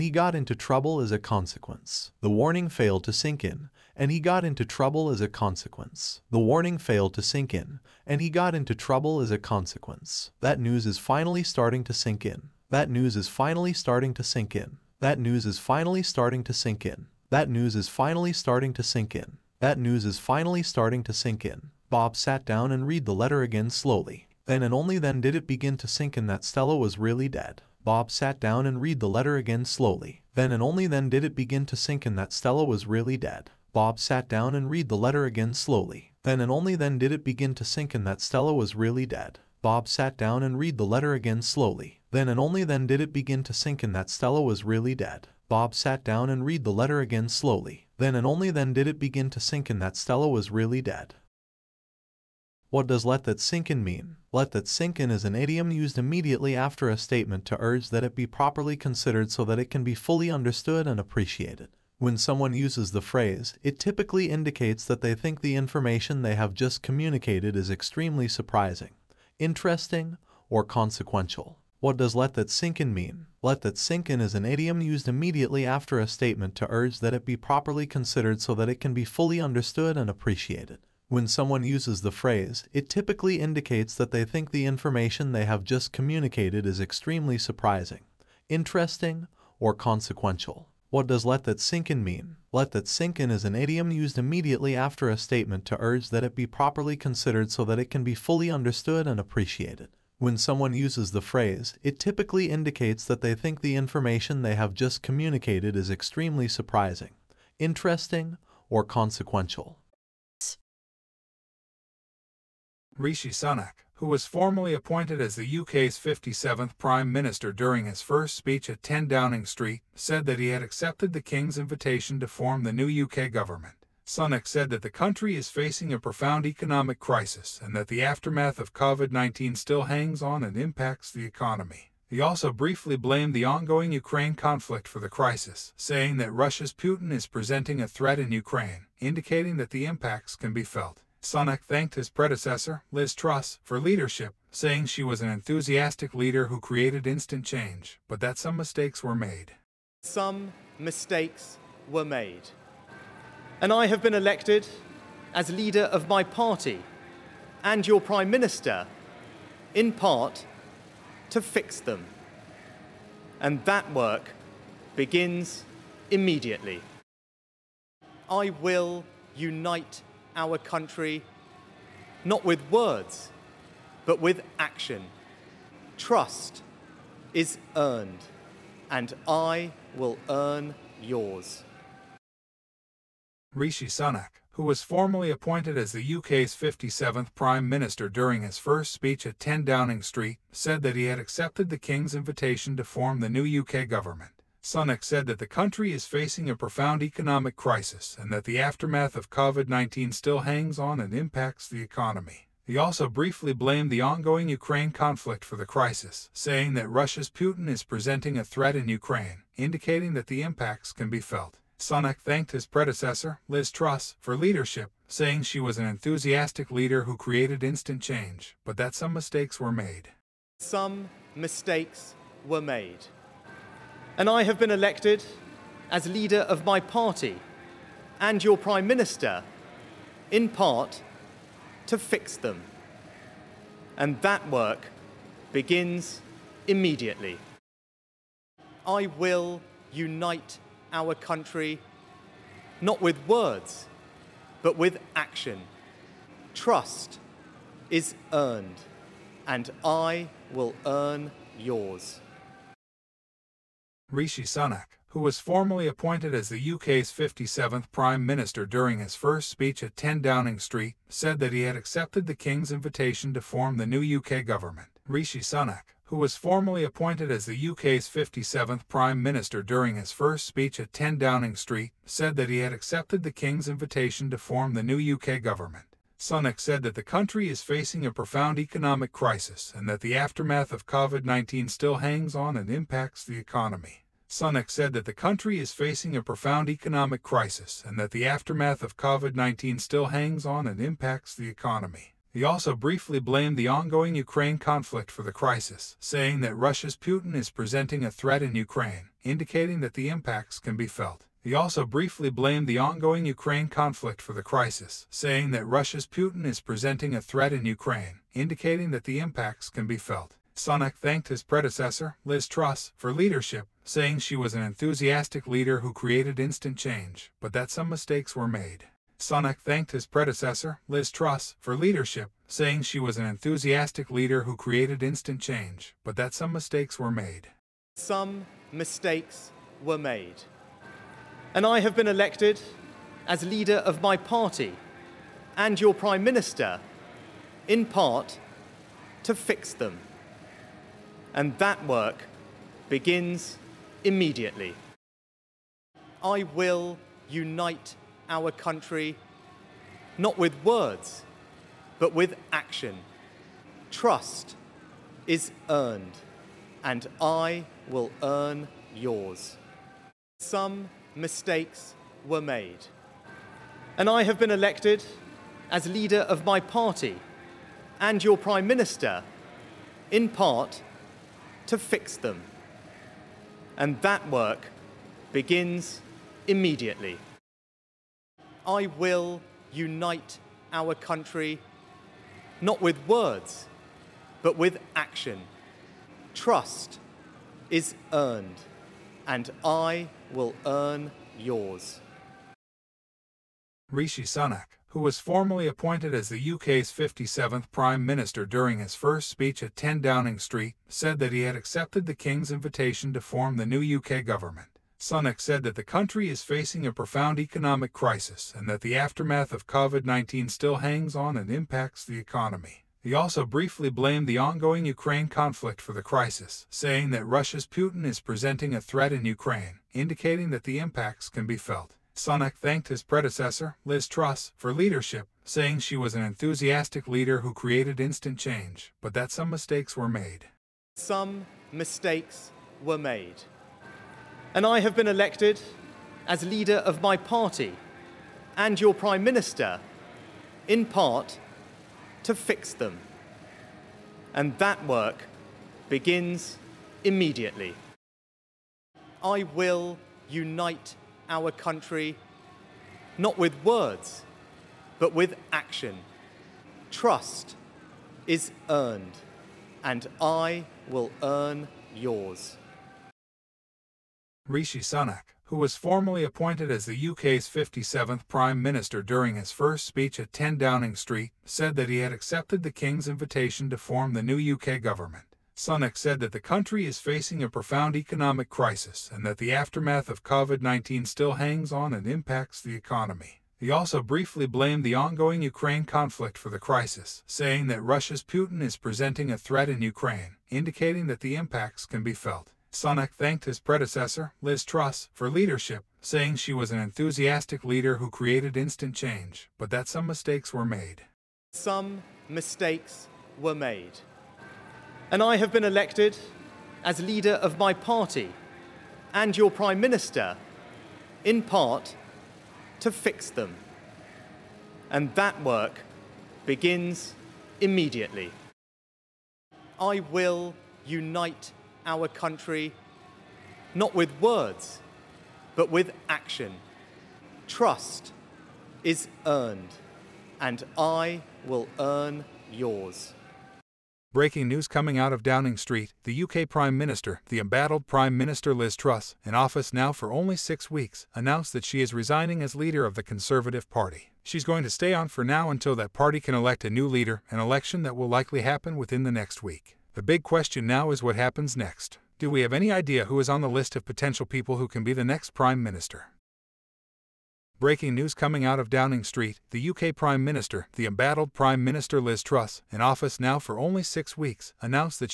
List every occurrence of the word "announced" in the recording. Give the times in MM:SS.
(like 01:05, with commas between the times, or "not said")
09:01, 09:24.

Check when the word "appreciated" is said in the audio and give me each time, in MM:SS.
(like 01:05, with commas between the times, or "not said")
01:00, 01:20, 01:39.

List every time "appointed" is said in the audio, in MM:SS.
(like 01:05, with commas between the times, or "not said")
01:54, 03:05, 04:15, 04:26, 06:35, 07:46.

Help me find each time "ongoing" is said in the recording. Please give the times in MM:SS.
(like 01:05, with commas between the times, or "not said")
02:13, 03:24, 04:53, 05:02, 06:54, 08:04.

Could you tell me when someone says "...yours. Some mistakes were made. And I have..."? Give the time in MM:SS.
05:58.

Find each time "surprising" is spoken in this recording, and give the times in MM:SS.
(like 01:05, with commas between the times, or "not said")
01:08, 01:27, 01:46.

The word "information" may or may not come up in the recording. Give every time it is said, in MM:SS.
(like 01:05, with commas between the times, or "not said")
01:05, 01:24, 01:43.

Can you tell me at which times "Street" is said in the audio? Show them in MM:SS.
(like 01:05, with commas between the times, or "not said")
01:59, 03:10, 04:20, 04:31, 06:40, 07:50, 08:55, 09:19.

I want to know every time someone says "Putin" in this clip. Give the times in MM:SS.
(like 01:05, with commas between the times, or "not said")
02:16, 03:27, 04:56, 05:06, 06:57, 08:08.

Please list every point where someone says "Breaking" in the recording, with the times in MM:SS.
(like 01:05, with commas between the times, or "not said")
08:54, 09:17.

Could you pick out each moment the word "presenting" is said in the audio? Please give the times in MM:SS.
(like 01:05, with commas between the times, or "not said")
02:17, 03:27, 04:57, 05:06, 06:58, 08:08.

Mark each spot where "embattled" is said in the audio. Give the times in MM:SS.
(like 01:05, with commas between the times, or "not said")
08:57, 09:20.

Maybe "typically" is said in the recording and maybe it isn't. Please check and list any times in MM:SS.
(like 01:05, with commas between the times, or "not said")
01:03, 01:22, 01:41.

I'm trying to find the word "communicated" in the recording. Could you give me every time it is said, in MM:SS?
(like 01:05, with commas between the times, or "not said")
01:06, 01:25, 01:45.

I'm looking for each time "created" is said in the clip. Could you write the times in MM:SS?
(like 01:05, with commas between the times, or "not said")
02:26, 03:37, 05:15, 05:24, 07:07, 08:18.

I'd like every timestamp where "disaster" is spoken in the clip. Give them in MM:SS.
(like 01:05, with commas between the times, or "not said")
not said.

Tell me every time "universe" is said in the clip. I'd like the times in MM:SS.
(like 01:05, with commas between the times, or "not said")
not said.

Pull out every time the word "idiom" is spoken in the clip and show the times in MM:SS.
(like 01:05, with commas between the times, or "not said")
00:55, 01:14, 01:33.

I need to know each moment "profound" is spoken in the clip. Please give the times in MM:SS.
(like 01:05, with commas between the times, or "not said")
02:05, 03:16, 04:38, 04:46, 06:46, 07:57.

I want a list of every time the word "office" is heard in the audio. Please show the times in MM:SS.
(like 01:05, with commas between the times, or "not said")
08:59, 09:22.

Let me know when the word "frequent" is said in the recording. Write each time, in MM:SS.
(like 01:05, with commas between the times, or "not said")
not said.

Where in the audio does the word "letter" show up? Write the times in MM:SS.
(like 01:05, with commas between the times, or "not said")
00:23, 00:29, 00:34, 00:40, 00:46.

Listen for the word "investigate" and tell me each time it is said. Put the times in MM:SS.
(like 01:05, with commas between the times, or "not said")
not said.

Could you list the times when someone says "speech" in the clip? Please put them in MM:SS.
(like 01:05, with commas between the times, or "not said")
01:58, 03:08, 04:19, 04:30, 06:39, 07:49.